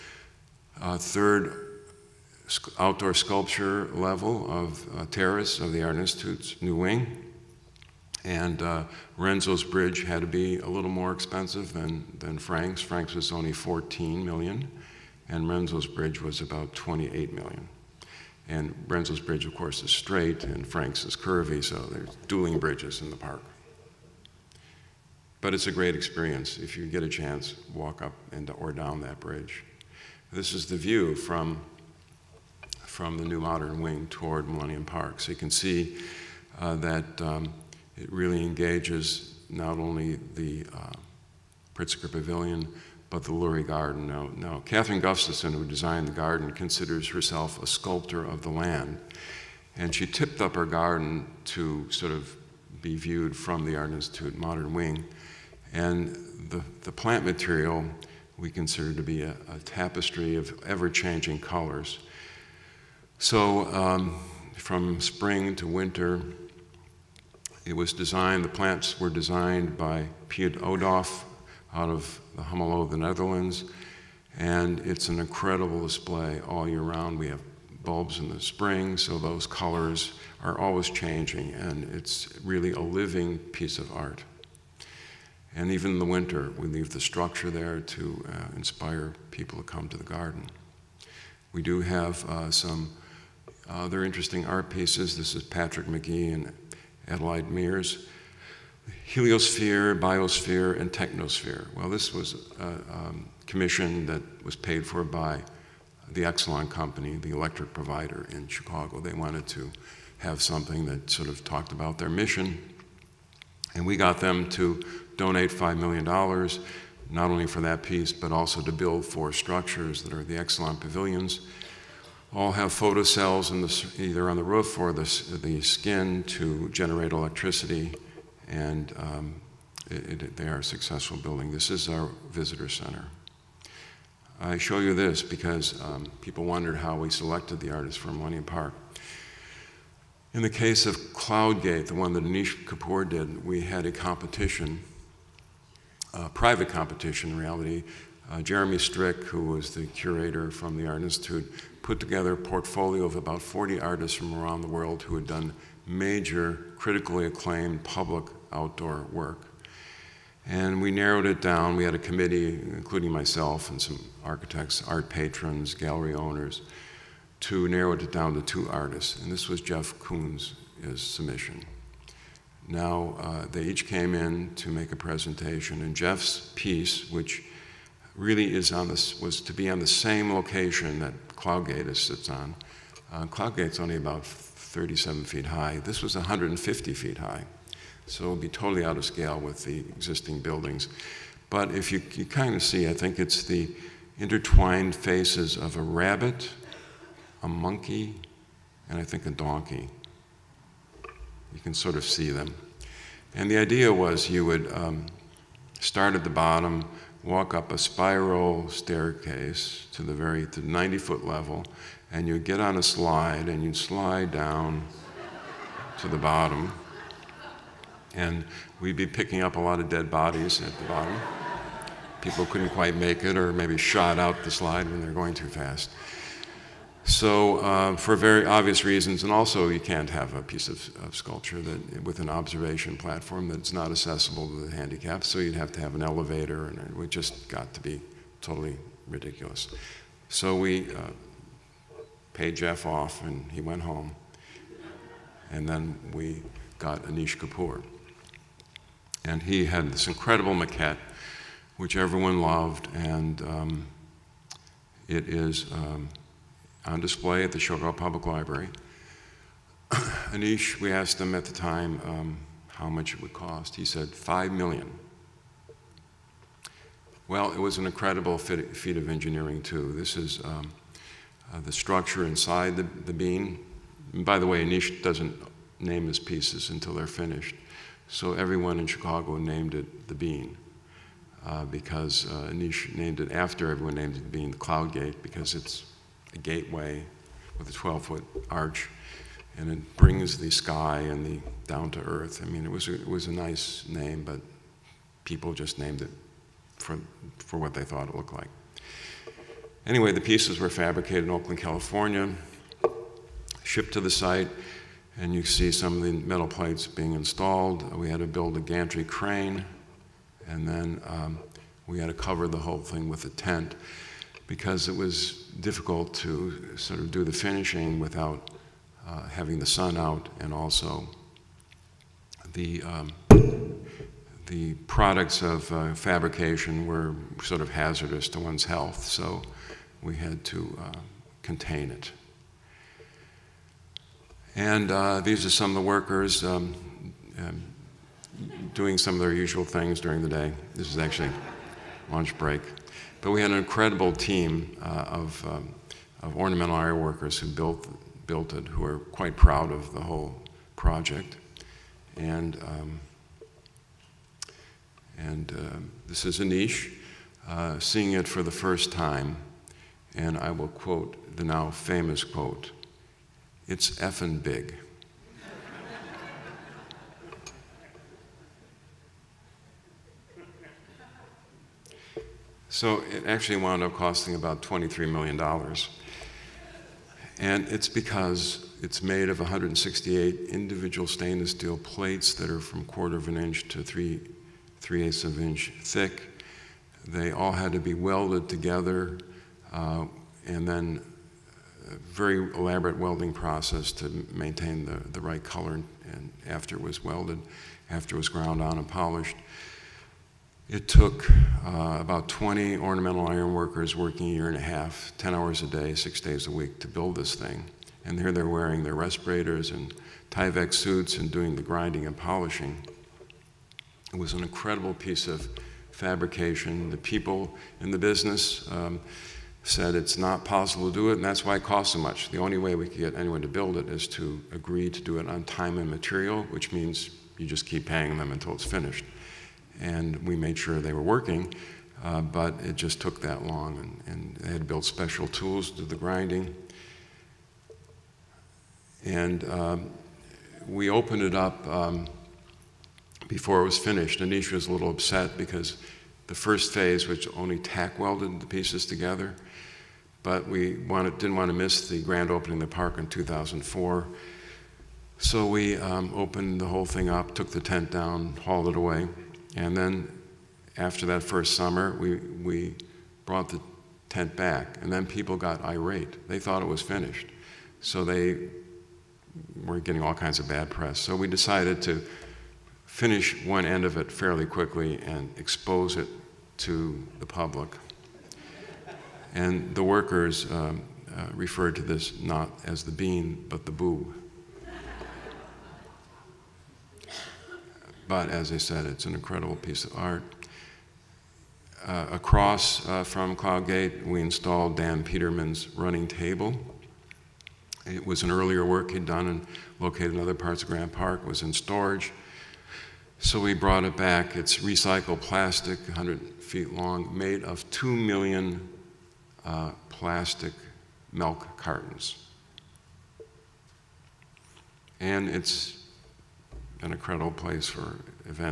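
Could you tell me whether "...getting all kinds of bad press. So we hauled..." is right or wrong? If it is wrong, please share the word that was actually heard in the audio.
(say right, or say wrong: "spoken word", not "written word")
wrong: "decided", not "hauled".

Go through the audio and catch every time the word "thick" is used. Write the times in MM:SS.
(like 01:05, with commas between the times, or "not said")
06:25.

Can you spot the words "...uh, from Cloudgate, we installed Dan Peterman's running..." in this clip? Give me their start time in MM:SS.
08:12.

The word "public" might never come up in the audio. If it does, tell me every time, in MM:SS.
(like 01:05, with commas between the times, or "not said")
02:37, 04:17, 07:57.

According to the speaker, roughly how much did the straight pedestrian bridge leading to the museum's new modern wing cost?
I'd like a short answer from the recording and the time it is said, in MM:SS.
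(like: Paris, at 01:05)
$28 million, at 00:16.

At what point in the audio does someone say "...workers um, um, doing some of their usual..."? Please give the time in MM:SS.
05:35.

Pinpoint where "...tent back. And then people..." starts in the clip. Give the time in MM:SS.
07:44.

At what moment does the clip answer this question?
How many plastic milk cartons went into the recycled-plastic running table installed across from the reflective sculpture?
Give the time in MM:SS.
08:27.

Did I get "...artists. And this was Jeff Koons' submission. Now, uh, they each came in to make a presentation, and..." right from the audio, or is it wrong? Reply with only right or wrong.
right.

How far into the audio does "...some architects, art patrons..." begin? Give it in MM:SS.
02:43.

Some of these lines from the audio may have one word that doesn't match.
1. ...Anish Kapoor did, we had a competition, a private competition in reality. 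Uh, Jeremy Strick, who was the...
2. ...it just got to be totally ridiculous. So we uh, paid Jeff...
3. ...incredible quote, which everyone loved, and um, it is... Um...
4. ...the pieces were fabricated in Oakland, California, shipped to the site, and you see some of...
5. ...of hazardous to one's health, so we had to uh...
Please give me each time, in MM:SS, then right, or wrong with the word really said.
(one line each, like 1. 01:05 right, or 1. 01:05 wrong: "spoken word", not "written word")
1. 02:22 right
2. 03:56 right
3. 04:10 wrong: "maquette", not "quote"
4. 05:00 right
5. 05:27 right.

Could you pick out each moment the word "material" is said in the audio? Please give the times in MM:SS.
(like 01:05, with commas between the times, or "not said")
00:57, 07:05.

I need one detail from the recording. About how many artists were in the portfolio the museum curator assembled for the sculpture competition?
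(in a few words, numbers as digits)
40.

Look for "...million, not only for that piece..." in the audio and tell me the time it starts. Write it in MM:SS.
01:55.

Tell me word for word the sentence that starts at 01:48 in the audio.
They wanted to have something that sort of talked about their mission.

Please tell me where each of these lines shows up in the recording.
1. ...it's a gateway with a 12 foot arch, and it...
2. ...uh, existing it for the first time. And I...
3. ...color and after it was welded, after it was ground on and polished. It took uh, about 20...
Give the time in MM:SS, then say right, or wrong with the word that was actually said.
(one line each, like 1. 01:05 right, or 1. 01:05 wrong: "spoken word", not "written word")
1. 04:45 right
2. 05:57 wrong: "seeing", not "existing"
3. 06:35 right.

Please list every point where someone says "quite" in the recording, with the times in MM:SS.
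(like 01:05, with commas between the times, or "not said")
03:42, 05:48.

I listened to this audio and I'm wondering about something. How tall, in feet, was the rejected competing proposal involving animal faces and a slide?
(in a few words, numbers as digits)
150 feet.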